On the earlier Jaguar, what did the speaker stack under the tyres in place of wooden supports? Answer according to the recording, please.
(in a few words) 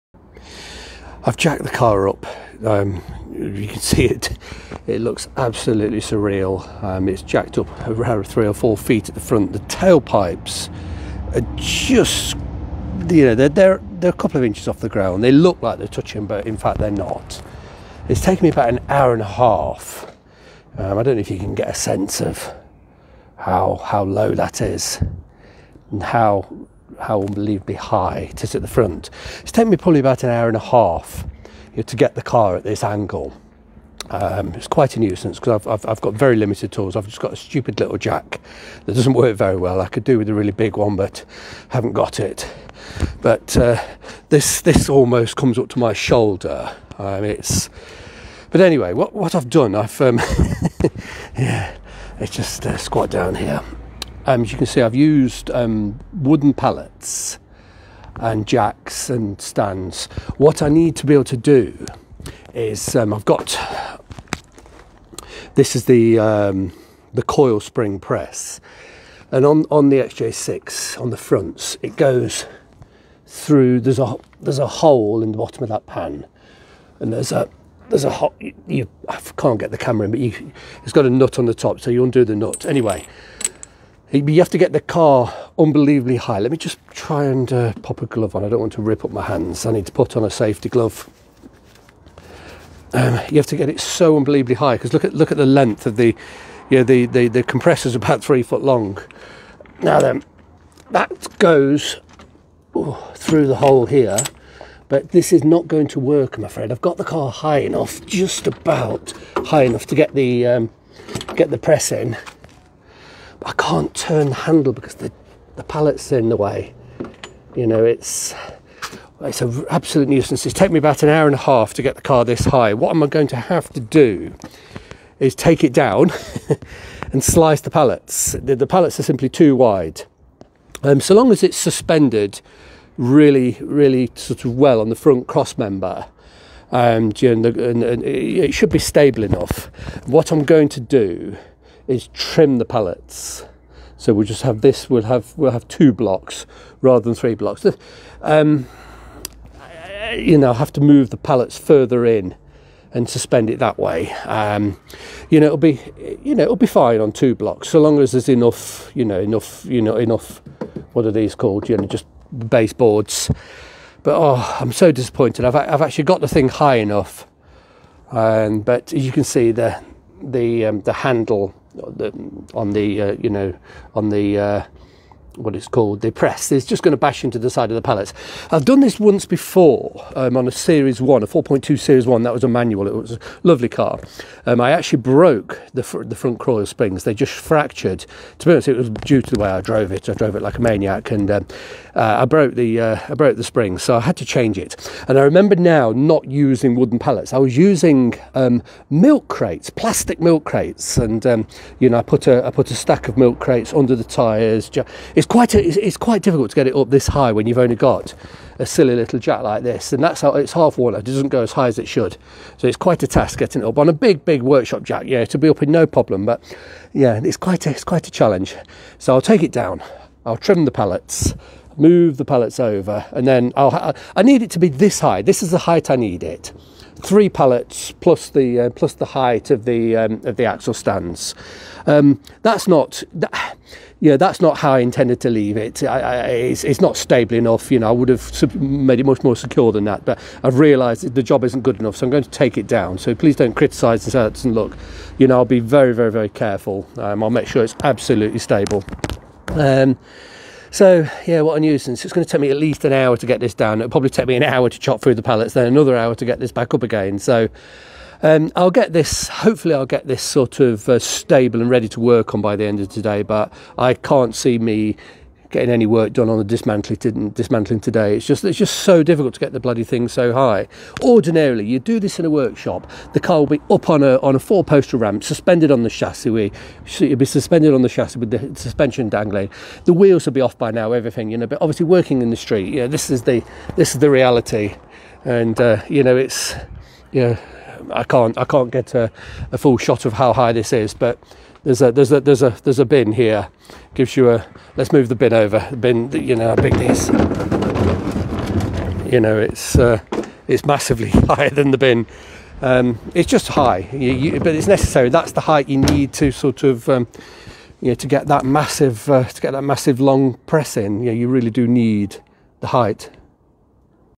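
plastic milk crates.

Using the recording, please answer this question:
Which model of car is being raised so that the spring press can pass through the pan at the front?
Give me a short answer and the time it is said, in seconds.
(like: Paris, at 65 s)
XJ6, at 69 s.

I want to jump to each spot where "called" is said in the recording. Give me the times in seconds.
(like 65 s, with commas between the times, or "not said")
161 s, 175 s.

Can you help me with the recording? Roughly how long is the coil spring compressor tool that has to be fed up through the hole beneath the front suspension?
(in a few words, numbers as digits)
3 foot.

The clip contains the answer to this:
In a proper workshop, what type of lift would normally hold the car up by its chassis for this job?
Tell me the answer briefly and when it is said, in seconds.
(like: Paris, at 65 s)
four poster ramp, at 274 s.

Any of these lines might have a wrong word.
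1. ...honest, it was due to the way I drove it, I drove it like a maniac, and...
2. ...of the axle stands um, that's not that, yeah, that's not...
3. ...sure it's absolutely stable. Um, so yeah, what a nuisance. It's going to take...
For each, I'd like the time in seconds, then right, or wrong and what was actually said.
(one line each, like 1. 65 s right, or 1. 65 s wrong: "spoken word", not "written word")
1. 188 s right
2. 230 s right
3. 247 s right.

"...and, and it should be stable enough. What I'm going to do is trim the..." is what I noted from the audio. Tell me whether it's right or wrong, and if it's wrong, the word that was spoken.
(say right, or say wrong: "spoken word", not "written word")
right.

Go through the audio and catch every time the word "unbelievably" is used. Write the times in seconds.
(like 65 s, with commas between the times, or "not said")
27 s, 85 s, 94 s.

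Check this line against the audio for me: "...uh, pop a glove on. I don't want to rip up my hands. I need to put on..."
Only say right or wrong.
right.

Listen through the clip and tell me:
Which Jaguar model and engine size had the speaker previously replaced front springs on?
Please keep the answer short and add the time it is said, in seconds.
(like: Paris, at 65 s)
4.2 Series 1, at 181 s.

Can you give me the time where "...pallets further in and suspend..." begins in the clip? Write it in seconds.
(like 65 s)
151 s.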